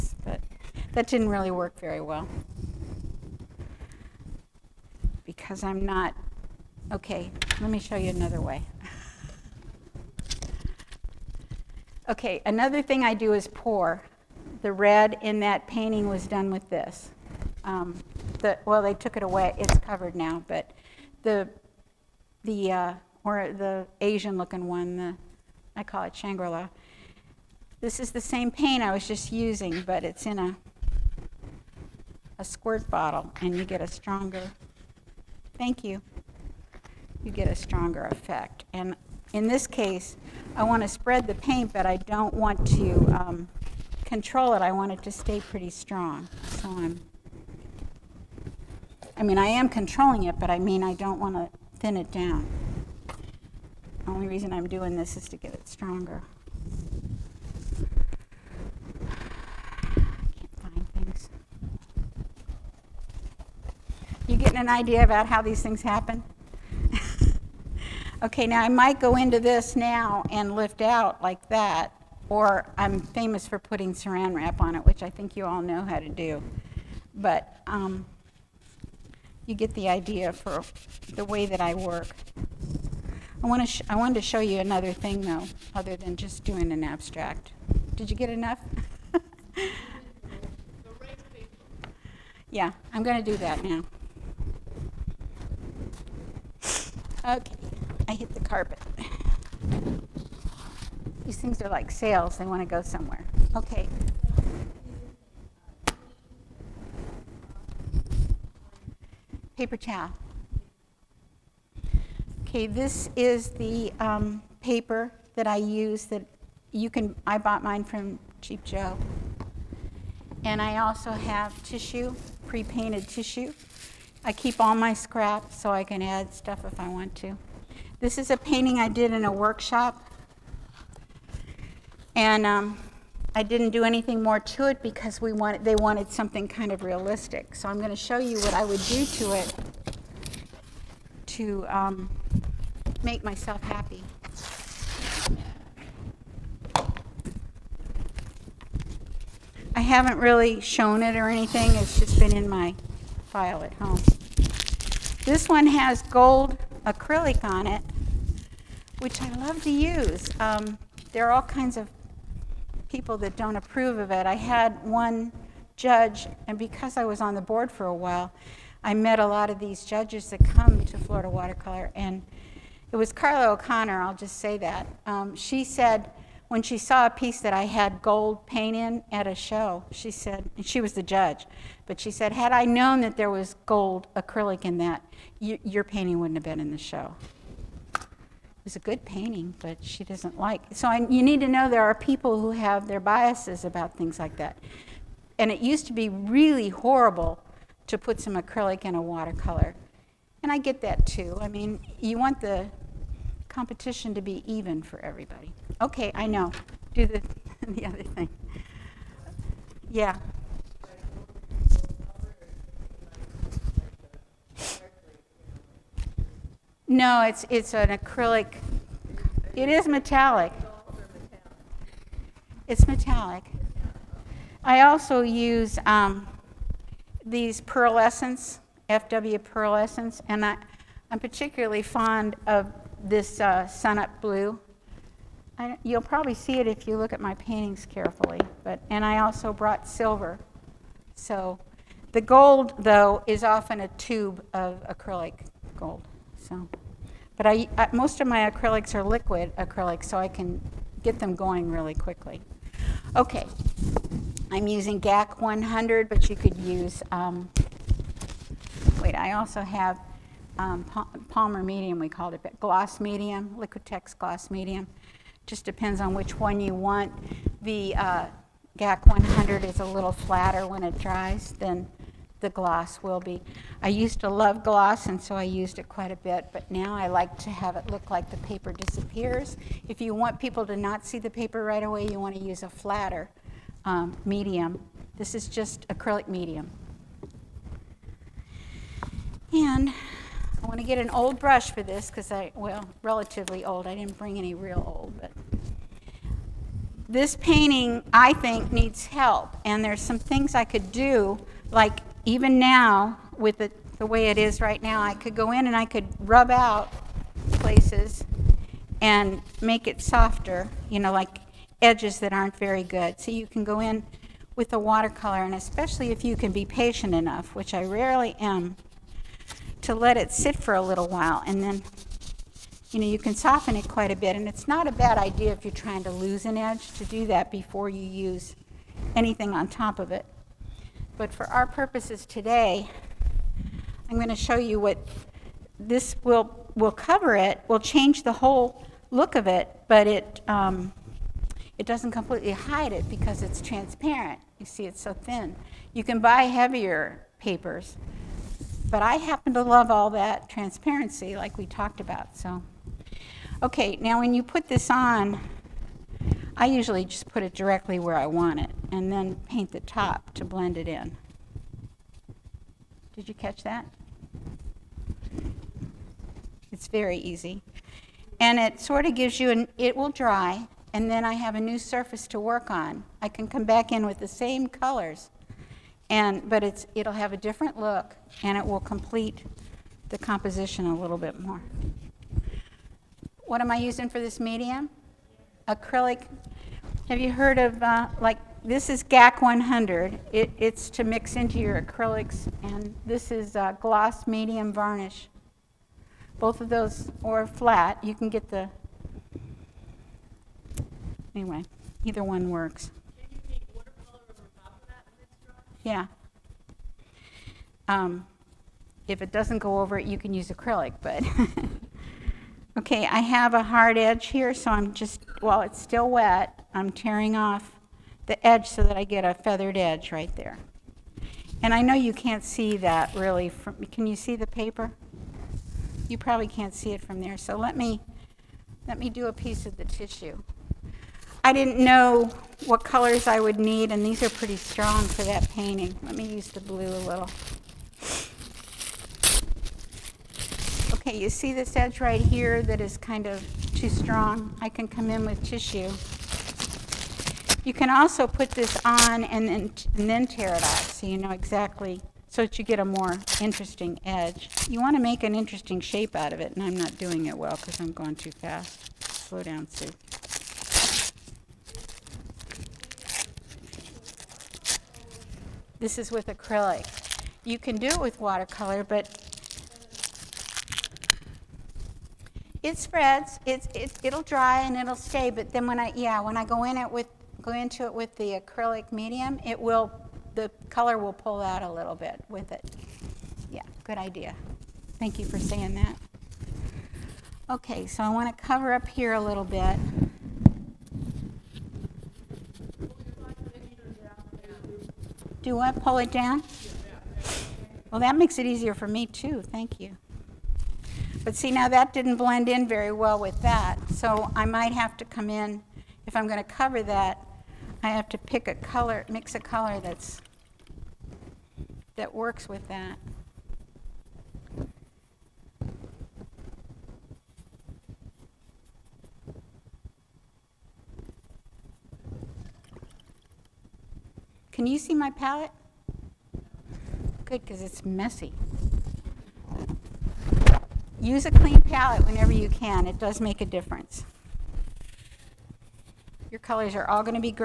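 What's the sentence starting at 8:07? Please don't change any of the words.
Okay, so I want to cover up here a little bit.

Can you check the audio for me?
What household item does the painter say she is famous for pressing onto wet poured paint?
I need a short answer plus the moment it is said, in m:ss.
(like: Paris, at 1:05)
saran wrap, at 1:13.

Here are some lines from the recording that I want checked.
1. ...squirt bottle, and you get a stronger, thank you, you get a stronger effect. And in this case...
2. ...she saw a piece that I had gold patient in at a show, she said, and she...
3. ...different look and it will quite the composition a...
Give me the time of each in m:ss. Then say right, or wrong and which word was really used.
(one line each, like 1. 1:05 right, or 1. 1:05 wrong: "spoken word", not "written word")
1. 0:32 right
2. 2:56 wrong: "paint", not "patient"
3. 6:17 wrong: "complete", not "quite".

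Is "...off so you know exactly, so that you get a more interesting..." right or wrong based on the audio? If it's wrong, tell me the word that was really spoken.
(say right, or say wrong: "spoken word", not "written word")
right.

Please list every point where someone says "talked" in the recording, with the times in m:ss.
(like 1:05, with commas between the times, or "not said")
5:51.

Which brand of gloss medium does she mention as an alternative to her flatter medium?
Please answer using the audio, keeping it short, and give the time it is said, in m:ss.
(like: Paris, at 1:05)
Liquitex, at 4:23.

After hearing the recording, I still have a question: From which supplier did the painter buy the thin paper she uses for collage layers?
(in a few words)
Cheap Joe.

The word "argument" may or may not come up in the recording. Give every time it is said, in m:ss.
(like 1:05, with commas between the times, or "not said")
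not said.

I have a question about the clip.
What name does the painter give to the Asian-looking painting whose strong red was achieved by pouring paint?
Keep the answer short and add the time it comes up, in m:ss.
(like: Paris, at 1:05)
Shangri-La, at 0:26.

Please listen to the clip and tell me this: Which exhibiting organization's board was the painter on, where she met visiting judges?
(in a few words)
Florida Watercolor.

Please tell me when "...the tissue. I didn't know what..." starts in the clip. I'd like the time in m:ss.
7:09.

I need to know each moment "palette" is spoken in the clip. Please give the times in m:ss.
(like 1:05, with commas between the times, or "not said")
8:45, 8:51.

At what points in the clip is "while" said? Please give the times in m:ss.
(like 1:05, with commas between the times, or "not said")
2:47, 5:21, 6:55.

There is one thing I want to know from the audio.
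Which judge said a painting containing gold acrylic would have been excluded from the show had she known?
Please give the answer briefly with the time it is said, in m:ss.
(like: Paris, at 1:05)
Carla O'Connor, at 2:53.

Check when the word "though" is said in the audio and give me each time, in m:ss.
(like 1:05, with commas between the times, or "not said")
1:25, 4:02.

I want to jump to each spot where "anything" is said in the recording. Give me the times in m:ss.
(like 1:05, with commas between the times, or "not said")
2:13, 2:31, 5:29.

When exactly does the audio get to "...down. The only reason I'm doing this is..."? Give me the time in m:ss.
0:52.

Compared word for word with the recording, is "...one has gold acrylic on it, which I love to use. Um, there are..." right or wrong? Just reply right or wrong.
right.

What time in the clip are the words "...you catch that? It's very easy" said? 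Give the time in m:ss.
6:03.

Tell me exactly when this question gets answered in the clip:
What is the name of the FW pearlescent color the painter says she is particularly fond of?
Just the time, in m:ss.
3:53.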